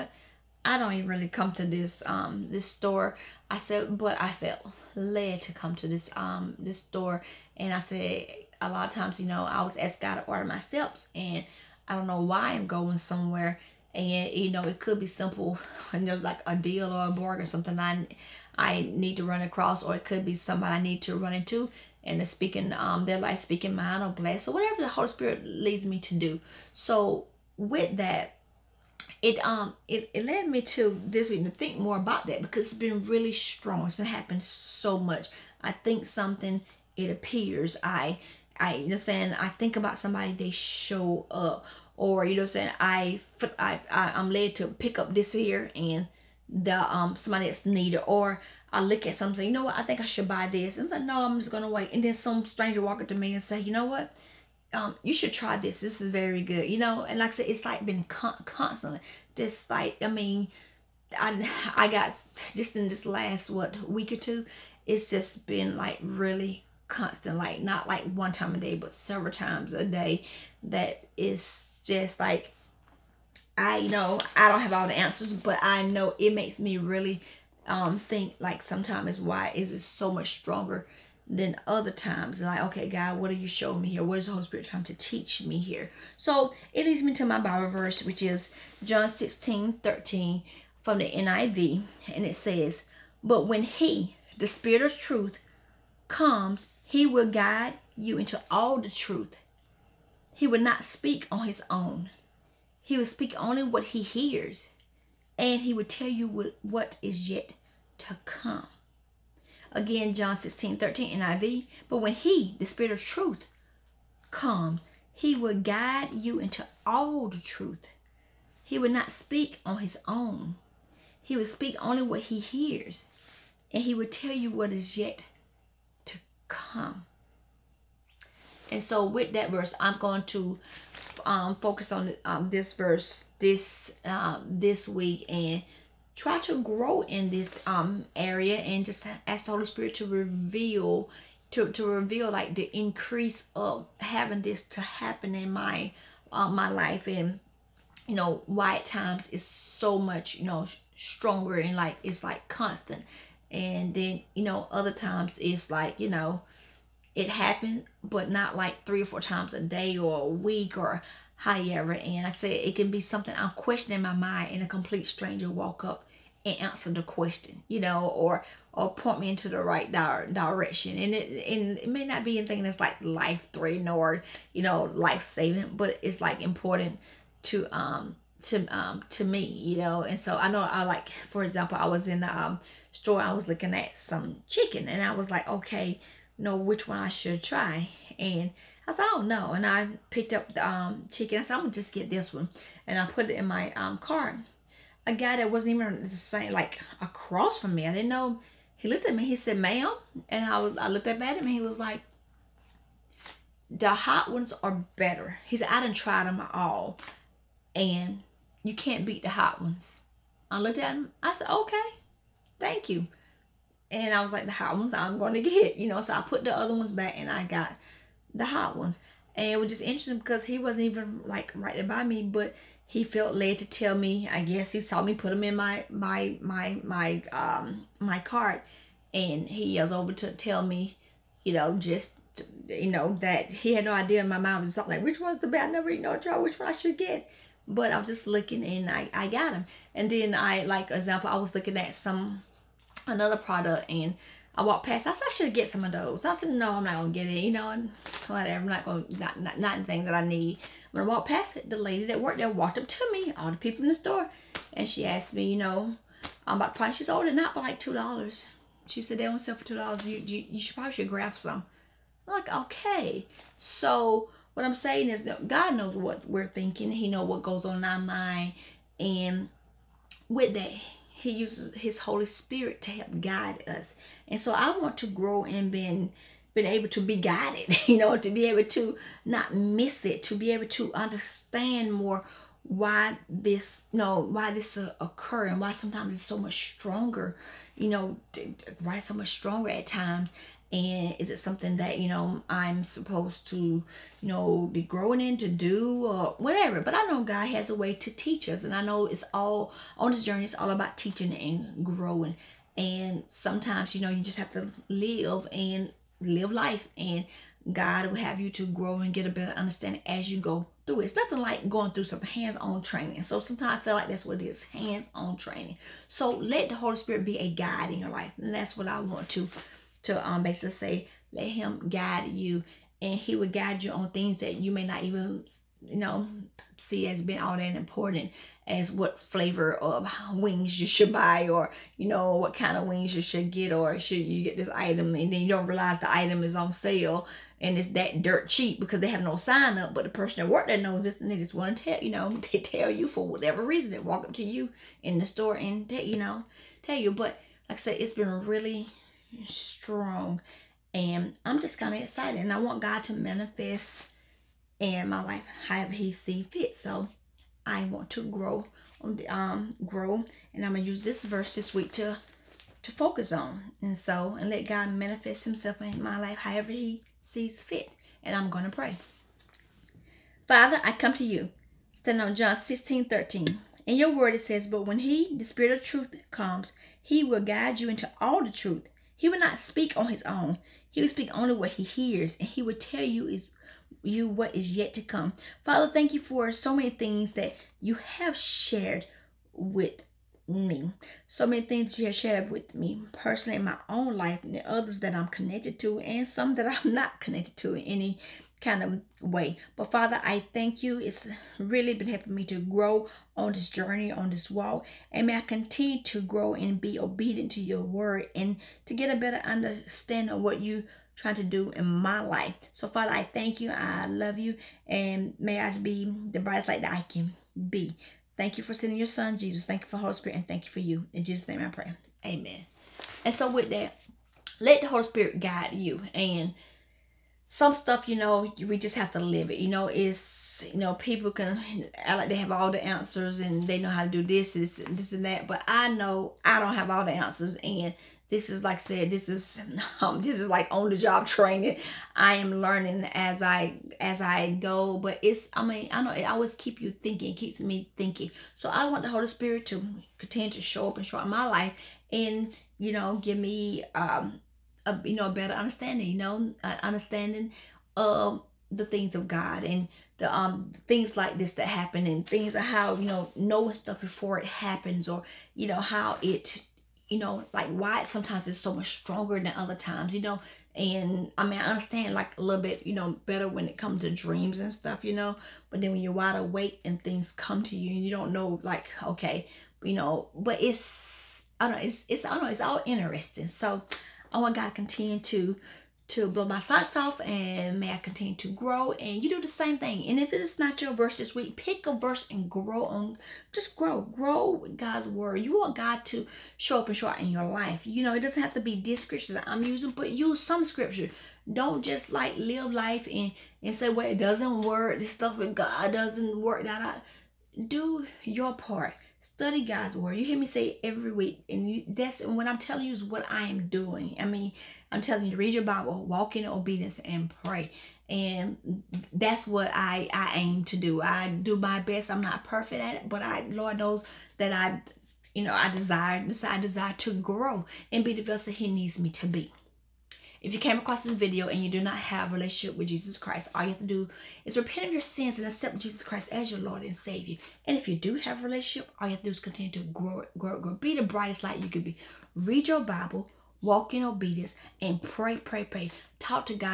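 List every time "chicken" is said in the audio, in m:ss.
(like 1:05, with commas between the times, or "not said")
3:04, 3:11.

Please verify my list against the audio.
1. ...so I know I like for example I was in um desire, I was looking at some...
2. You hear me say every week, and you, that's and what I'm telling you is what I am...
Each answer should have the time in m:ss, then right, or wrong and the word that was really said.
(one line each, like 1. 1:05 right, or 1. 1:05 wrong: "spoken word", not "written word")
1. 3:00 wrong: "store", not "desire"
2. 8:30 right.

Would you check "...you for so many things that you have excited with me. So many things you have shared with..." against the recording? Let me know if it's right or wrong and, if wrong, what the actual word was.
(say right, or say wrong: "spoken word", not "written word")
wrong: "shared", not "excited".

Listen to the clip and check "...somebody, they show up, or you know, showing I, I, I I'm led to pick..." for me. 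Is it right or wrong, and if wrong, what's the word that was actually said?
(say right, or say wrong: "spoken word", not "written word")
wrong: "saying", not "showing".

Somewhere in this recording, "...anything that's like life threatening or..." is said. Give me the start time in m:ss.
2:52.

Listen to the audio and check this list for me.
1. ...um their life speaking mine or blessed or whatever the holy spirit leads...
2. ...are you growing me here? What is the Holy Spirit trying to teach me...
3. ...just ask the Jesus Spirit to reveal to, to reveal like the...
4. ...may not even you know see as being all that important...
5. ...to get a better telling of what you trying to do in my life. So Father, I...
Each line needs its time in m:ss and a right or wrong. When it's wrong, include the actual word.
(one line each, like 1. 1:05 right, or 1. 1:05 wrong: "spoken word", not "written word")
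1. 0:22 right
2. 1:23 wrong: "showing", not "growing"
3. 2:18 wrong: "Holy", not "Jesus"
4. 5:24 right
5. 6:48 wrong: "understanding", not "telling".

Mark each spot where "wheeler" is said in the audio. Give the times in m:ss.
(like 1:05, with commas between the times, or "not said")
not said.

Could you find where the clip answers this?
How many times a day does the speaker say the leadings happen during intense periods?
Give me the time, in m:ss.
2:38.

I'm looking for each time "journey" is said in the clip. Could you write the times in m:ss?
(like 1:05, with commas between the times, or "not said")
5:00, 6:43.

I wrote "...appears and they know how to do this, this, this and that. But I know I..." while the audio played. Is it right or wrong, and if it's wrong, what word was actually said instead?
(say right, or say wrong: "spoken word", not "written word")
wrong: "answers", not "appears".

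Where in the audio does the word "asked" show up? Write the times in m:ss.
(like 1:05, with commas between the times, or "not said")
0:09, 4:15.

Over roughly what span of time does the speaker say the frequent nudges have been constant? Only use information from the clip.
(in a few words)
week or two.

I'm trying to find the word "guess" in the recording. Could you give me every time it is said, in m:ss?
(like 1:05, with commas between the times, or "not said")
3:44.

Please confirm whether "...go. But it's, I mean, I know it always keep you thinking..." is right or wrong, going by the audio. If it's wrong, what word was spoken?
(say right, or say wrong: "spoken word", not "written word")
right.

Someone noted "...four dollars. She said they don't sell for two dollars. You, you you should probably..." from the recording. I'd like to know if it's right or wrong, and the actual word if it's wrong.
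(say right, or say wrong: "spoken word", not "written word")
wrong: "two", not "four".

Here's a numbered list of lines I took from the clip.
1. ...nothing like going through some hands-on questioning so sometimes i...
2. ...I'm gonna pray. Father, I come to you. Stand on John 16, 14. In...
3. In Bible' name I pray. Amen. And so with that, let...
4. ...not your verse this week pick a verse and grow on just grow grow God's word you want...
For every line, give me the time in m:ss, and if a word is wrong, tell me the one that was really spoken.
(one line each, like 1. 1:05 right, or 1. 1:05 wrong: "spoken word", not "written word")
1. 5:11 wrong: "training", not "questioning"
2. 6:08 wrong: "13", not "14"
3. 7:01 wrong: "Jesus", not "Bible"
4. 8:10 right.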